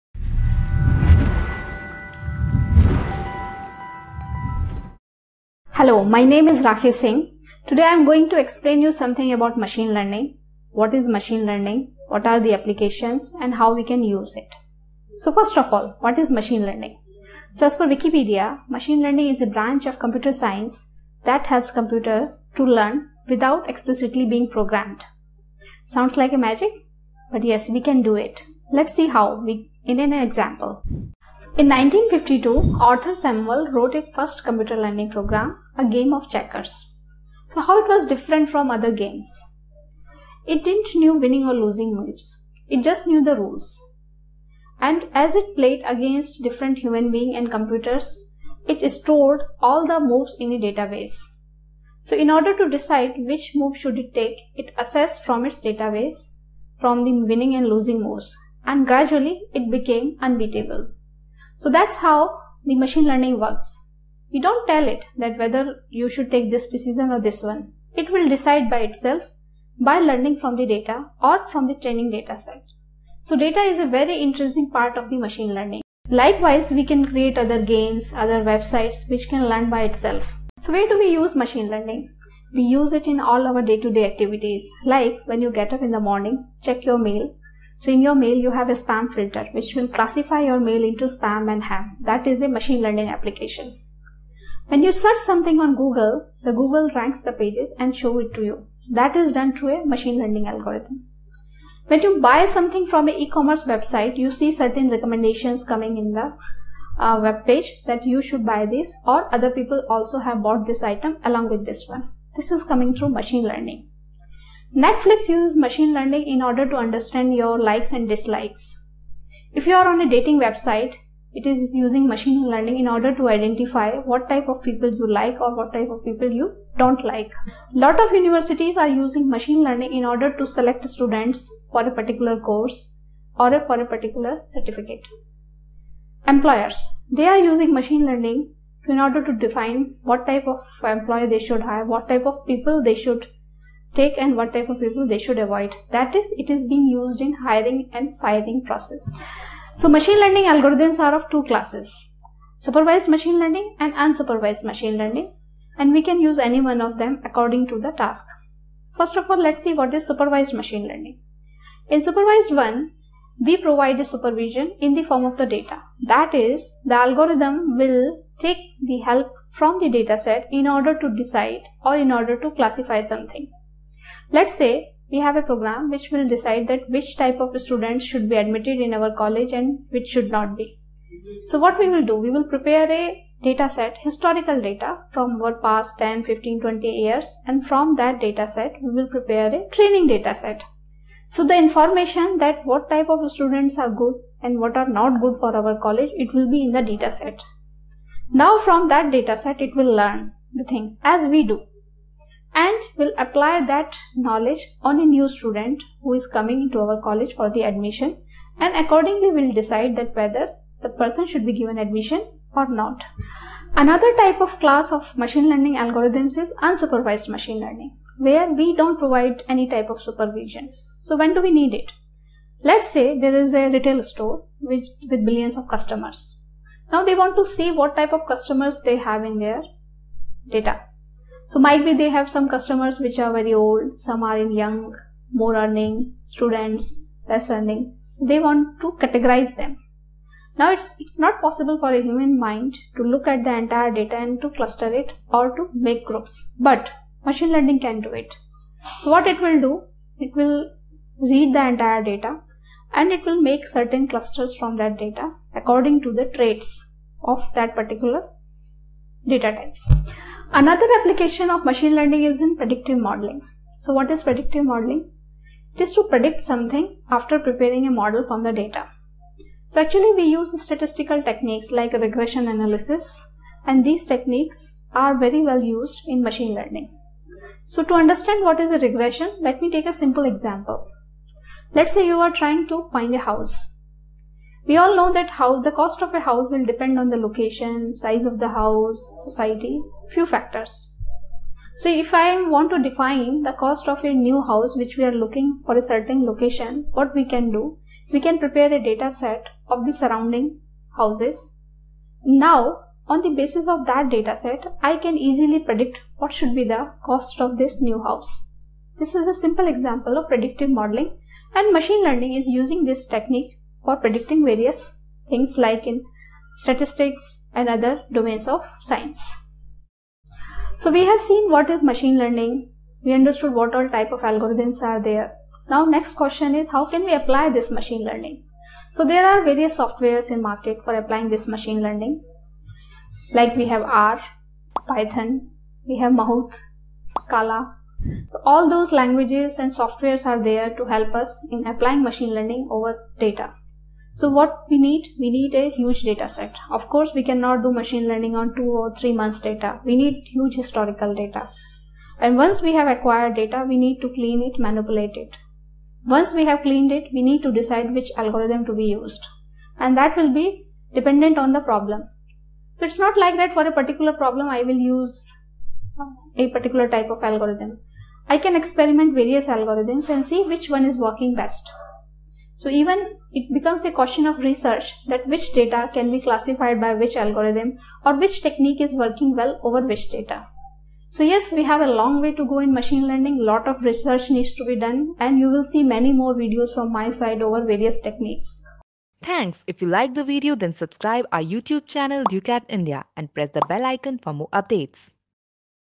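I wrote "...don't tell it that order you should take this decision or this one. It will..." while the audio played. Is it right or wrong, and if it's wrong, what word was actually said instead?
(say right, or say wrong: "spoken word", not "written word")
wrong: "whether", not "order".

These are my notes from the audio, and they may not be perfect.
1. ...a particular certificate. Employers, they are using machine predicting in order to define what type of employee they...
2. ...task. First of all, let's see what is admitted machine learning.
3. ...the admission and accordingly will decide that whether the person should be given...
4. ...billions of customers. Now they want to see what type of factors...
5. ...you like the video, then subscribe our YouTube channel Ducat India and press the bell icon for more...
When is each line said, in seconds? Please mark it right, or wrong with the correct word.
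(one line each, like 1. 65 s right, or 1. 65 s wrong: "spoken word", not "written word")
1. 133 s wrong: "learning", not "predicting"
2. 157 s wrong: "supervised", not "admitted"
3. 207 s right
4. 225 s wrong: "customers", not "factors"
5. 389 s right.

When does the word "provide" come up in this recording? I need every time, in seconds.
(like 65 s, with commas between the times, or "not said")
163 s, 218 s.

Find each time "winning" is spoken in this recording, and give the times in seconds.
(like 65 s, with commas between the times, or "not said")
41 s, 57 s.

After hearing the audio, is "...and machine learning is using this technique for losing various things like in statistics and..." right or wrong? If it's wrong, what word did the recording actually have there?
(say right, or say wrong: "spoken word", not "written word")
wrong: "predicting", not "losing".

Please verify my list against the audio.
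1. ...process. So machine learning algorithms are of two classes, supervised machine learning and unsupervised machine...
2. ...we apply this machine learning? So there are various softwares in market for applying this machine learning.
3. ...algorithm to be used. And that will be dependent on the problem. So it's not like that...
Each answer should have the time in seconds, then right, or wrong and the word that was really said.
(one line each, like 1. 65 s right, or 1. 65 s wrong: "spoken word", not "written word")
1. 148 s right
2. 327 s right
3. 358 s right.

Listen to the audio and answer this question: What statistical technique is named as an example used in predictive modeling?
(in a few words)
regression analysis.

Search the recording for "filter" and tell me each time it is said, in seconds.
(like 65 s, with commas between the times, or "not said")
89 s.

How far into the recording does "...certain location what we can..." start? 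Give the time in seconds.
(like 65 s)
295 s.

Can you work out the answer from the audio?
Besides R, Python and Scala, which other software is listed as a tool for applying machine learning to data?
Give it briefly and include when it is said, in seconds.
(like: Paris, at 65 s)
Mahout, at 336 s.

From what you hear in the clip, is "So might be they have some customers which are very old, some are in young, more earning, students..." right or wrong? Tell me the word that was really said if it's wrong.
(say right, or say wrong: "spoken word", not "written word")
right.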